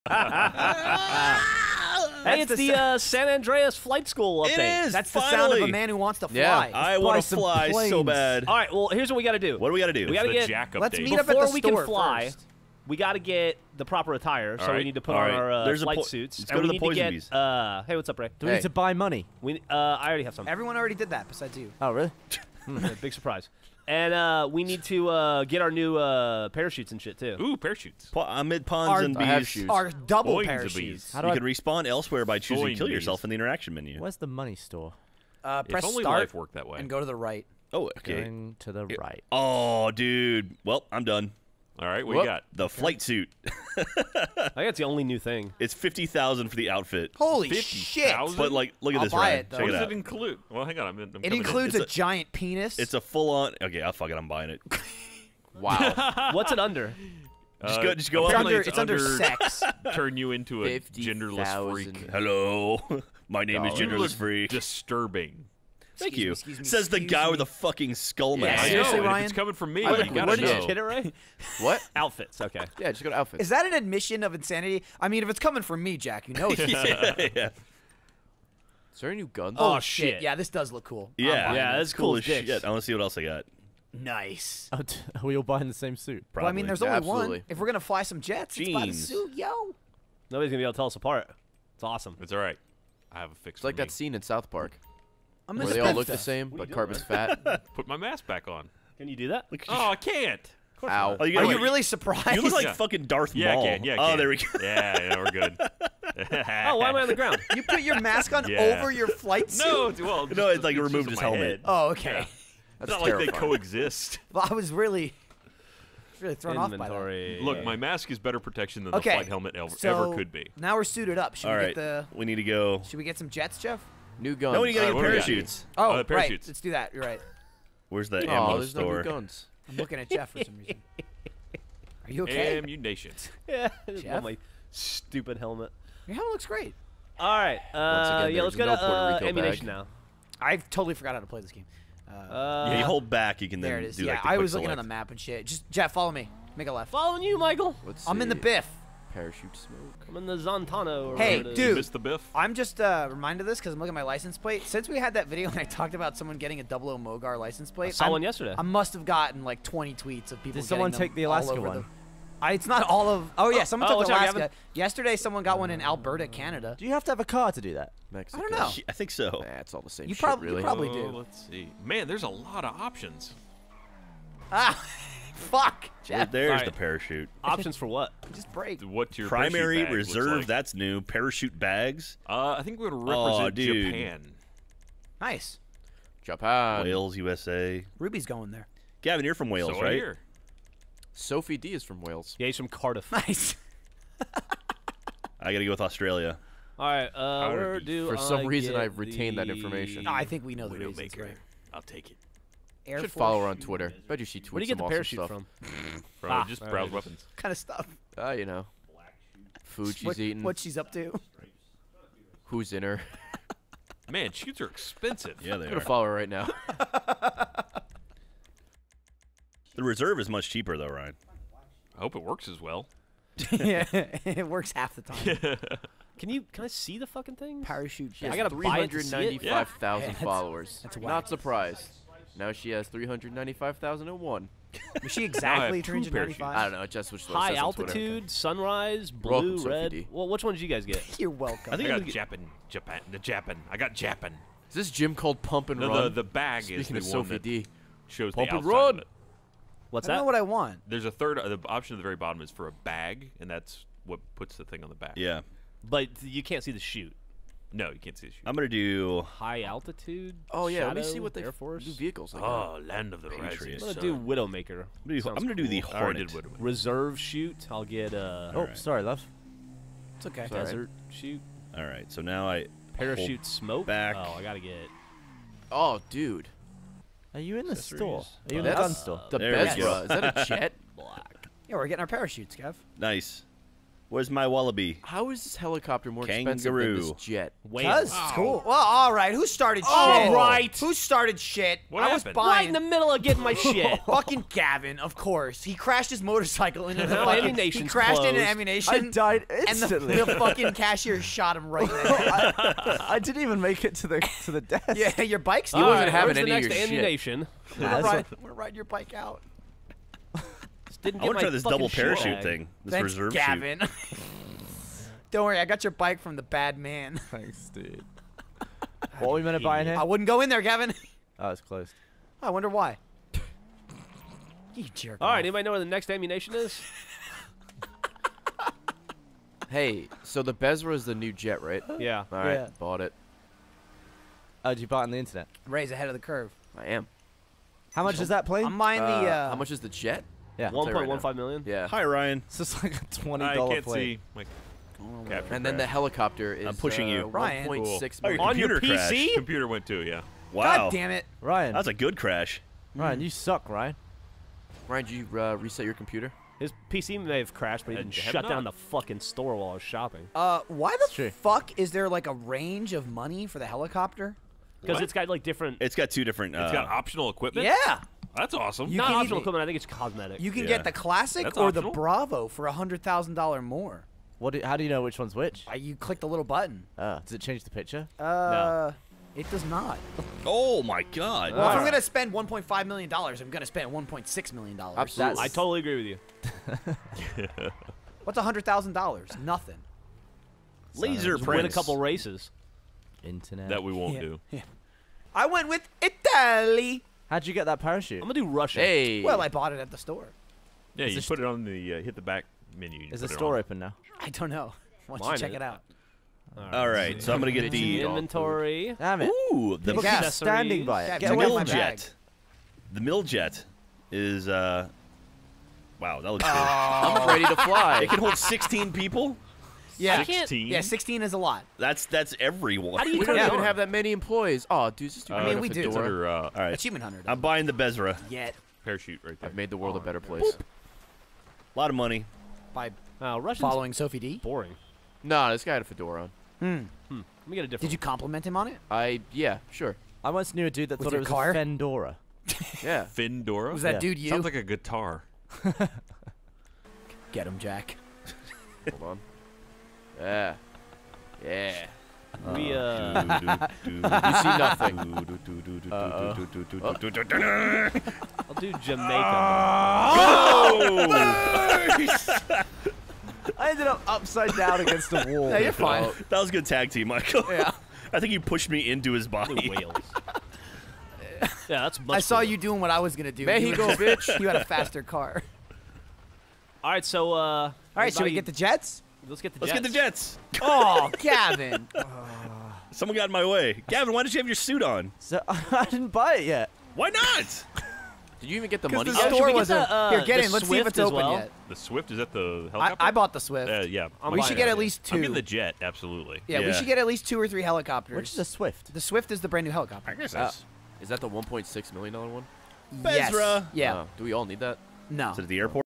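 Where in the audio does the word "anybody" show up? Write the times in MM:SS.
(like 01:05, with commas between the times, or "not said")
05:25.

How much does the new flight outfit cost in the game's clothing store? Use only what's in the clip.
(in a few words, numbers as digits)
50,000.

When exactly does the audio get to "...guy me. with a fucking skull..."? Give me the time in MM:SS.
01:06.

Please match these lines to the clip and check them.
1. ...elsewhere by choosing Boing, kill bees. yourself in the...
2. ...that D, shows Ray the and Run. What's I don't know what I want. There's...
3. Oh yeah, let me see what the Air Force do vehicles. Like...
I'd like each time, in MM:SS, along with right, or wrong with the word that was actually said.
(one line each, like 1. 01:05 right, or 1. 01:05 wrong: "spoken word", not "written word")
1. 00:31 right
2. 04:07 wrong: "Pump", not "Ray"
3. 04:20 right.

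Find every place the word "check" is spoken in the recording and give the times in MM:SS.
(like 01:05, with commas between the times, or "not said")
00:49, 06:45.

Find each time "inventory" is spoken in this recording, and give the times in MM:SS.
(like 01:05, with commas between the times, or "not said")
01:56, 06:48.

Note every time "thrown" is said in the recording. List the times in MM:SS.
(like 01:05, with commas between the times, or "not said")
01:56.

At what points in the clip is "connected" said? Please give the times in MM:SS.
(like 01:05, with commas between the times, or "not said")
not said.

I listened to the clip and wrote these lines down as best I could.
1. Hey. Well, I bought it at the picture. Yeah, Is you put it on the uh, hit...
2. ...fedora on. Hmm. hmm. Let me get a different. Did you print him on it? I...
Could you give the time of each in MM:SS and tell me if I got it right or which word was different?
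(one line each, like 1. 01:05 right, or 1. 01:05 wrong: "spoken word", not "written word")
1. 06:38 wrong: "store", not "picture"
2. 07:15 wrong: "compliment", not "print".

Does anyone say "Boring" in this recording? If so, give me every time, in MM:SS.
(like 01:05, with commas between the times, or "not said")
07:14.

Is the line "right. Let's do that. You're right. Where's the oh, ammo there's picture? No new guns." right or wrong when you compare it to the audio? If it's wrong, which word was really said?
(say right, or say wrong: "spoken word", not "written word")
wrong: "store", not "picture".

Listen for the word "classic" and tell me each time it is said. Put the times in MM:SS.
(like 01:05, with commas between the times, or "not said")
06:10.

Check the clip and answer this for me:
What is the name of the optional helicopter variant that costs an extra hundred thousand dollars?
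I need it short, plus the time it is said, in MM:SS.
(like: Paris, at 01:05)
Bravo, at 06:11.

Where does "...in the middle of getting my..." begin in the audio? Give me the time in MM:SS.
04:52.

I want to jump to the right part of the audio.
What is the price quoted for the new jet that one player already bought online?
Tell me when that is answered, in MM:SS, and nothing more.
05:40.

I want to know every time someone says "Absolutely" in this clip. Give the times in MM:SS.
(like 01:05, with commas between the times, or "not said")
01:26, 06:24, 08:15.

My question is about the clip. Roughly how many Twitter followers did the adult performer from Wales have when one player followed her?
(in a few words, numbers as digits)
395,000.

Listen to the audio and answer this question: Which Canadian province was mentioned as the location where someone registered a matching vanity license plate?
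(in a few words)
Alberta.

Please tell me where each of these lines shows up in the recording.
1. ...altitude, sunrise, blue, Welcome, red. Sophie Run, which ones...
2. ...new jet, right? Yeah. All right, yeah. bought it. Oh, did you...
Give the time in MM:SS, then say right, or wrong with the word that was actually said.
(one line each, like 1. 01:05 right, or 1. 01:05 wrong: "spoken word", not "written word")
1. 03:57 wrong: "Well", not "Run"
2. 05:31 right.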